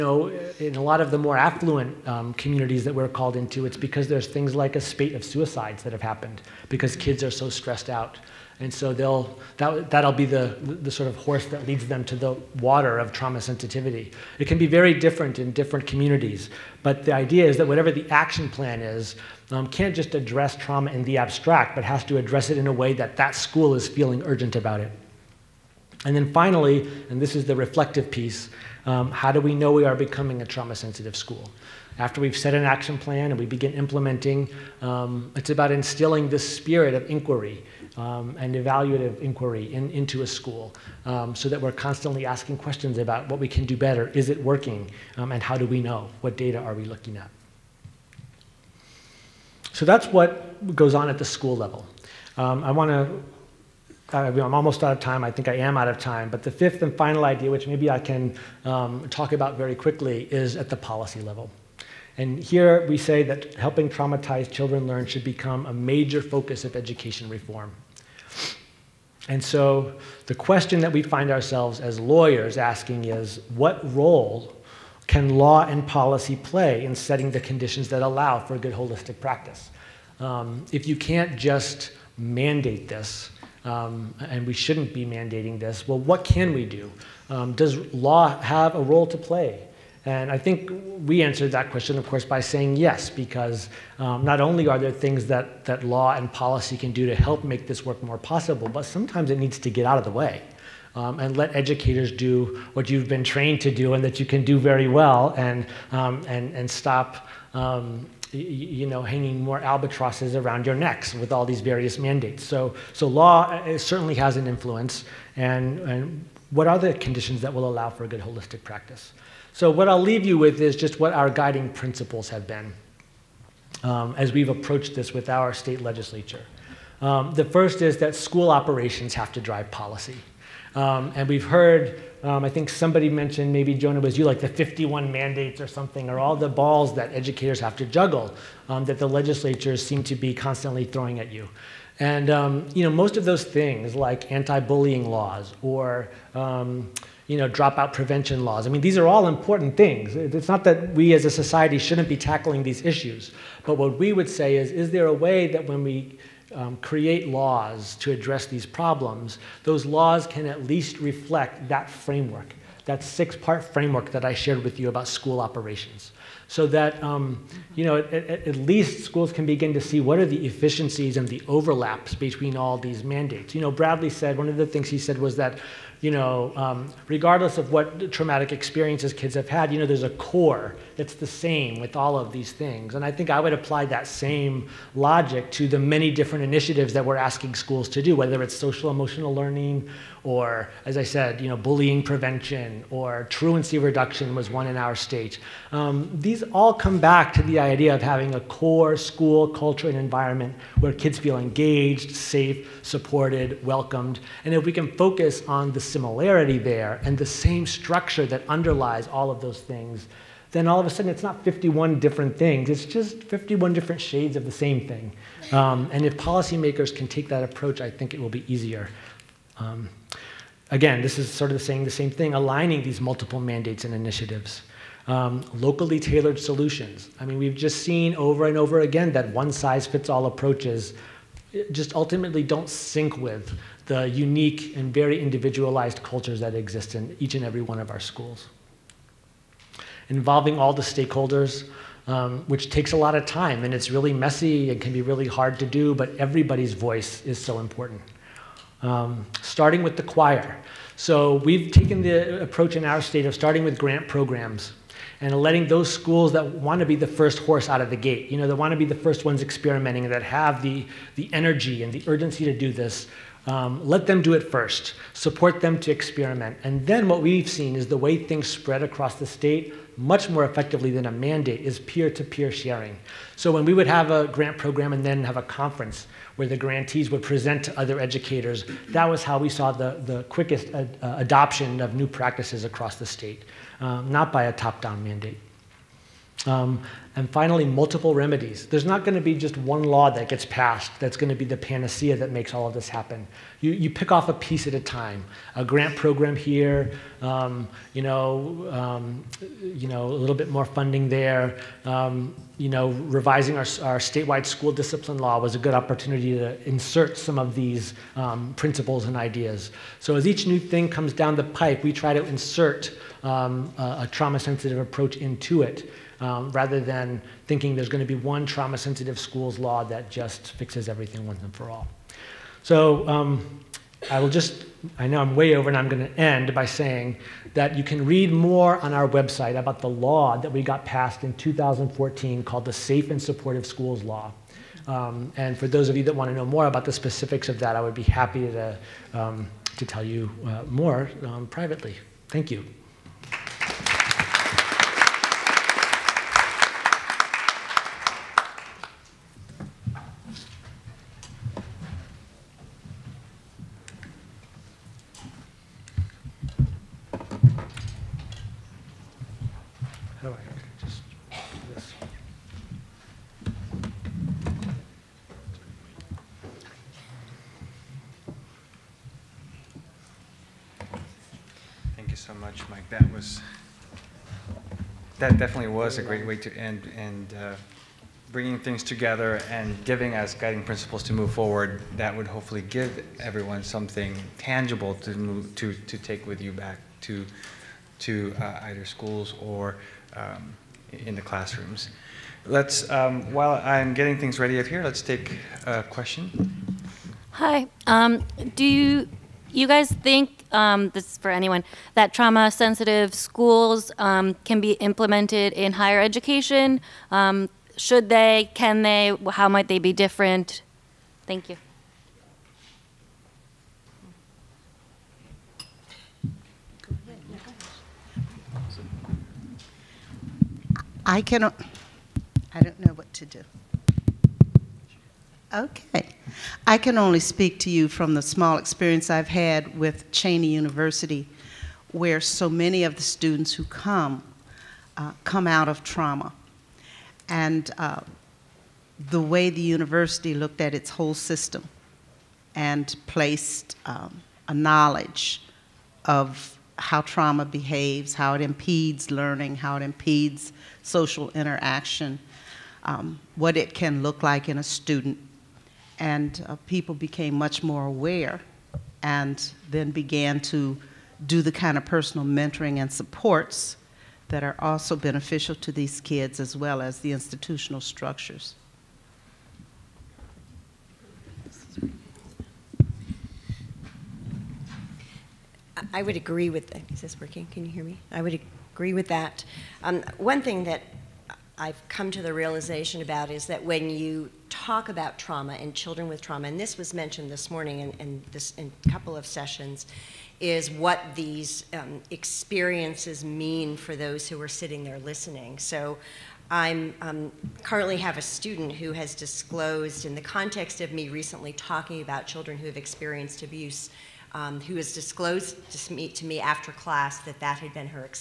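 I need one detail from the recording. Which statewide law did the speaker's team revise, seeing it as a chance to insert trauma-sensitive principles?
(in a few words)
school discipline law.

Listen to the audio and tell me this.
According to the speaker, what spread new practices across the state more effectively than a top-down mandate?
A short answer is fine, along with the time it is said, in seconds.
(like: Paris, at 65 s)
peer to peer sharing, at 271 s.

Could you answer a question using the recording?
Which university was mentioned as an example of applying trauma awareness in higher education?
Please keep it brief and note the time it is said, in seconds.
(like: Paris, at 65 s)
Cheyney University, at 430 s.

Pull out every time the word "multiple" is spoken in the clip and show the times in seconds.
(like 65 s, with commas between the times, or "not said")
222 s, 287 s.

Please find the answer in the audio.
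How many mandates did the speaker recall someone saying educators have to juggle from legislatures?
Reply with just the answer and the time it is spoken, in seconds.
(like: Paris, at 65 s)
51, at 134 s.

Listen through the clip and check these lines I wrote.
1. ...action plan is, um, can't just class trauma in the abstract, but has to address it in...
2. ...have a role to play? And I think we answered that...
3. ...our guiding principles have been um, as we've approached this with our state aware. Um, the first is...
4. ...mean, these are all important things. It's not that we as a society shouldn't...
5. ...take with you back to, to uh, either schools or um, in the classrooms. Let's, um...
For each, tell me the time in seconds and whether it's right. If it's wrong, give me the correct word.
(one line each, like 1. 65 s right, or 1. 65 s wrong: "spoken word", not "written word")
1. 18 s wrong: "address", not "class"
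2. 88 s right
3. 121 s wrong: "legislature", not "aware"
4. 148 s right
5. 385 s right.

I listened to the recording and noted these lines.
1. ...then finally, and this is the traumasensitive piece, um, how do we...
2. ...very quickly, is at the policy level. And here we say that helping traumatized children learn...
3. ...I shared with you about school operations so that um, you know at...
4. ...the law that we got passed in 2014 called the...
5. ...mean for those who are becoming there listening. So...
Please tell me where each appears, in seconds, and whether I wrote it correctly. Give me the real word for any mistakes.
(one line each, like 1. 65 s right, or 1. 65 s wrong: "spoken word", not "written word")
1. 26 s wrong: "reflective", not "traumasensitive"
2. 59 s right
3. 164 s right
4. 329 s right
5. 493 s wrong: "sitting", not "becoming".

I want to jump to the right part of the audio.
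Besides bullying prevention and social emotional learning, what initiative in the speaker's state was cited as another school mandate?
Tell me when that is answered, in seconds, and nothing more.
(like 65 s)
193 s.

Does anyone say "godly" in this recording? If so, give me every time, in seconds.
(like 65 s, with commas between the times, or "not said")
not said.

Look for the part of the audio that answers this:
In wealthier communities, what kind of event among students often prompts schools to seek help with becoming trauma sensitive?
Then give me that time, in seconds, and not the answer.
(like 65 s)
4 s.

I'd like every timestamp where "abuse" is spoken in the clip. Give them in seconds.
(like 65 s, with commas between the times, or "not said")
503 s.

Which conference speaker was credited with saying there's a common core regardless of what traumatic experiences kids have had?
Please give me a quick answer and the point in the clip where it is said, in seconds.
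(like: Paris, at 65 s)
Bradley, at 173 s.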